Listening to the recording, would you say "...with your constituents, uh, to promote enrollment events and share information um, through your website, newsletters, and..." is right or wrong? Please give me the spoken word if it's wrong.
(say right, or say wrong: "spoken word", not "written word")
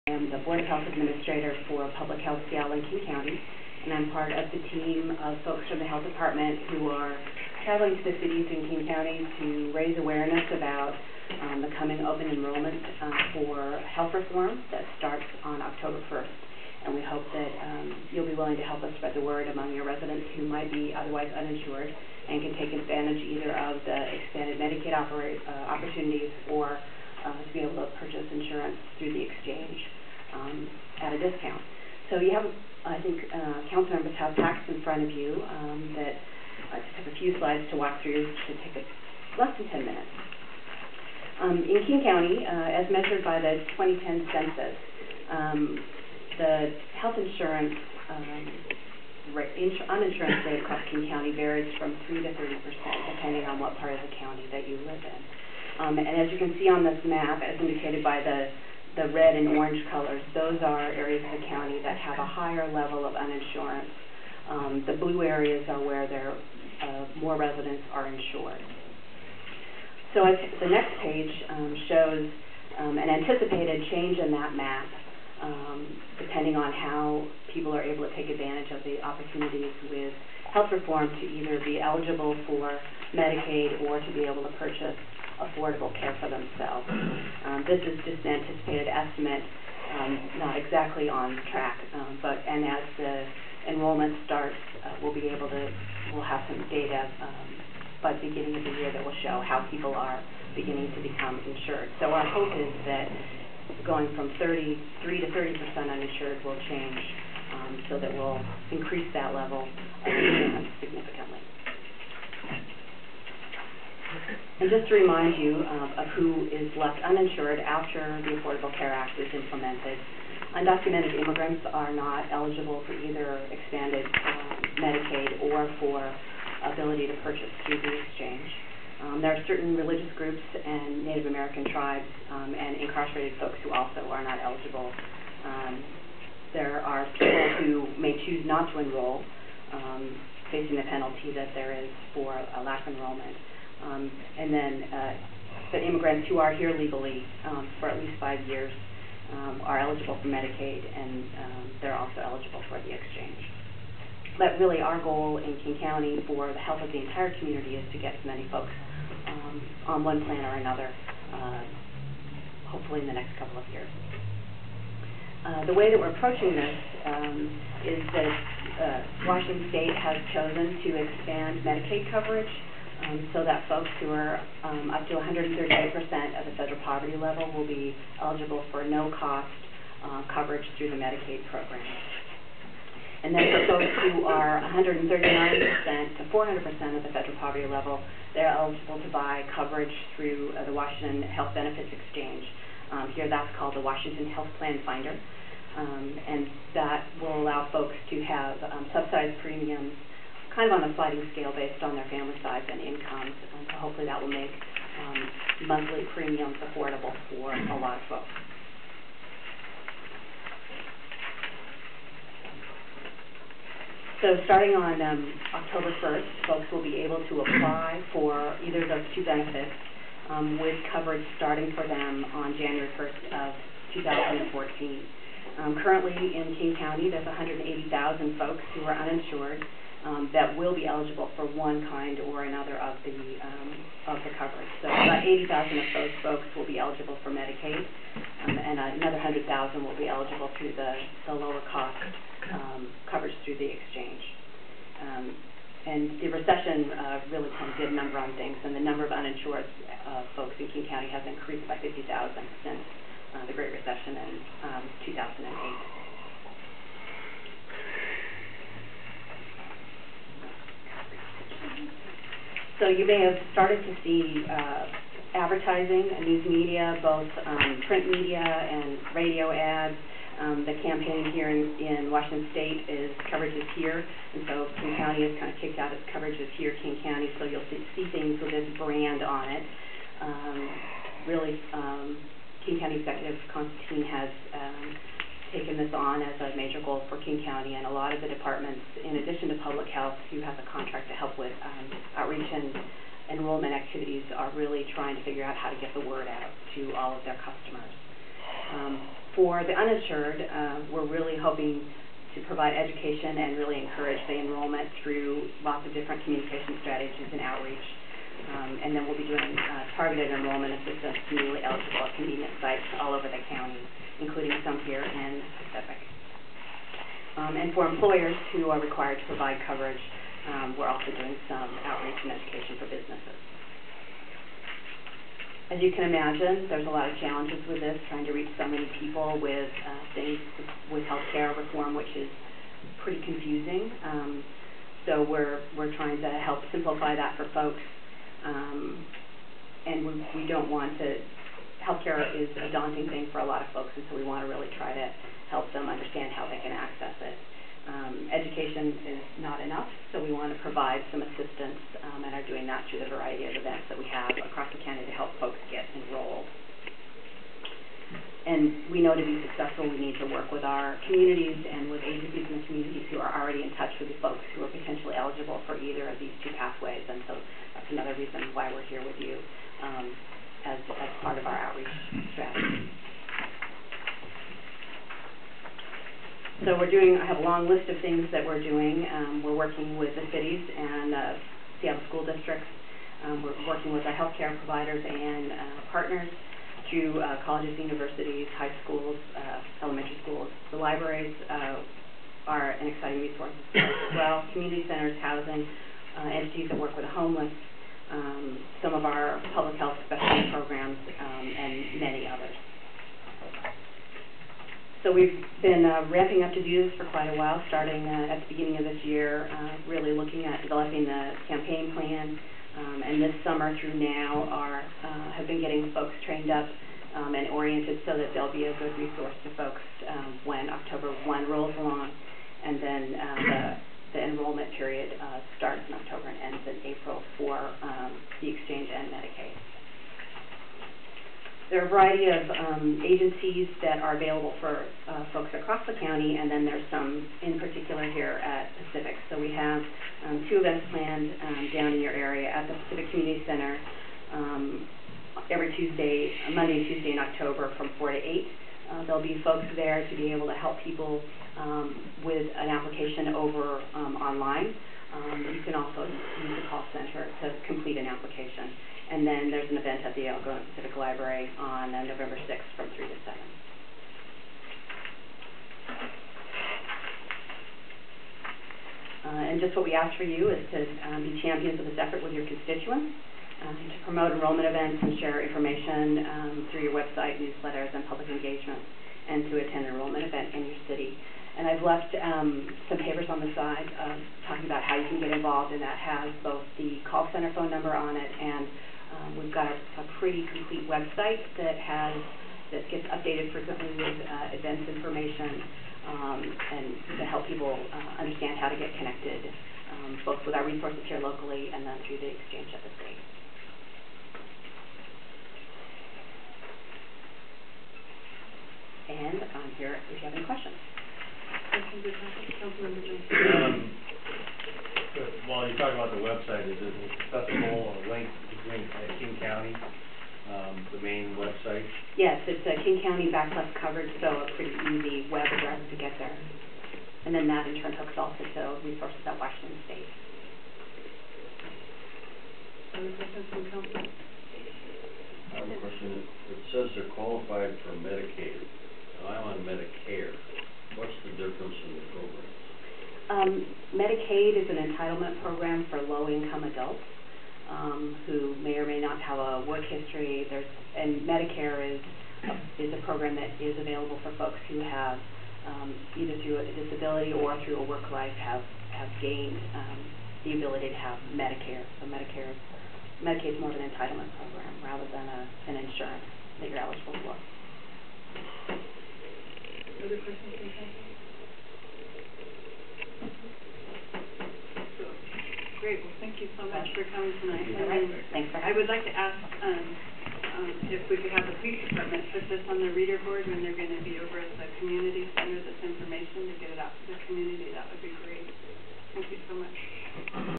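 right.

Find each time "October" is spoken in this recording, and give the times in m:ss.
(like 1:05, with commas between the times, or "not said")
0:15, 3:35, 7:00, 7:05, 7:27.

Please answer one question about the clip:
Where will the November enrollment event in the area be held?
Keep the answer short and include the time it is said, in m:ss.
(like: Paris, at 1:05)
Algona Pacific Library, at 7:40.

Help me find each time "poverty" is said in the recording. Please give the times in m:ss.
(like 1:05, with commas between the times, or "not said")
2:56, 3:07.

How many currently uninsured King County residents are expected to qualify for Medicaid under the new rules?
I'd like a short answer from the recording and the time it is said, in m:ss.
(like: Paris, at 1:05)
80,000, at 3:55.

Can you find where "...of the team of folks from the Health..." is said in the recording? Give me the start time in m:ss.
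0:04.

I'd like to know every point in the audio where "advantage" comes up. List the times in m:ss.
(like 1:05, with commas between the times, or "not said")
0:22, 1:18.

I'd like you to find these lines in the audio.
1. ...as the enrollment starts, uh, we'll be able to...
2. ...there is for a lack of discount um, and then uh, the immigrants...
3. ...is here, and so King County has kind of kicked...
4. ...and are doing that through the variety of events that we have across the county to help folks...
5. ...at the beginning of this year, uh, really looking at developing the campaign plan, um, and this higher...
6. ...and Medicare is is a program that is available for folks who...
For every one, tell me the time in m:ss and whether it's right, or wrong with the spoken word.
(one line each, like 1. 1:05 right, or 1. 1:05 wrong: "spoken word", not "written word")
1. 1:32 right
2. 2:21 wrong: "enrollment", not "discount"
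3. 4:33 right
4. 5:52 right
5. 6:48 wrong: "summer", not "higher"
6. 9:10 right.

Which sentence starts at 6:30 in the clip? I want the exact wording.
The libraries uh, are an exciting resource as well.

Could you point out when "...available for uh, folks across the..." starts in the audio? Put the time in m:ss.
7:14.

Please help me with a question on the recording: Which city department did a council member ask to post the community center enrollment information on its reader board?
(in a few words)
police department.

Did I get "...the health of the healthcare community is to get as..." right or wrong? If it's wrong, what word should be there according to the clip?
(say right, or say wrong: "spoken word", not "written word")
wrong: "entire", not "healthcare".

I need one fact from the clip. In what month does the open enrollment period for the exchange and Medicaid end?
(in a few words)
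April.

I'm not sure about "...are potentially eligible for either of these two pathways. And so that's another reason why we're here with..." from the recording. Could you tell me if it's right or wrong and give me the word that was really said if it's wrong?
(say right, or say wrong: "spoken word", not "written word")
right.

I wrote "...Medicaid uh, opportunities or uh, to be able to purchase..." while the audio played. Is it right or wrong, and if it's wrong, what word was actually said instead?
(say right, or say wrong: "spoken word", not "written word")
right.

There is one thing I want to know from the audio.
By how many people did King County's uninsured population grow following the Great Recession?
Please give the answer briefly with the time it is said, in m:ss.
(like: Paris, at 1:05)
50,000, at 4:11.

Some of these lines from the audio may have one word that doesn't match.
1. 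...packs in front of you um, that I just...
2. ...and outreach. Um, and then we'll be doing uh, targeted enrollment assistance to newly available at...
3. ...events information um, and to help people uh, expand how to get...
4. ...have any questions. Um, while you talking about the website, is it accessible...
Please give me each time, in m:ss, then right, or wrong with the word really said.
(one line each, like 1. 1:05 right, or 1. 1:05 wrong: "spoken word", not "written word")
1. 0:34 right
2. 5:07 wrong: "eligible", not "available"
3. 8:14 wrong: "understand", not "expand"
4. 8:30 right.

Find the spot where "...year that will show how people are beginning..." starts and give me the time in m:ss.
1:38.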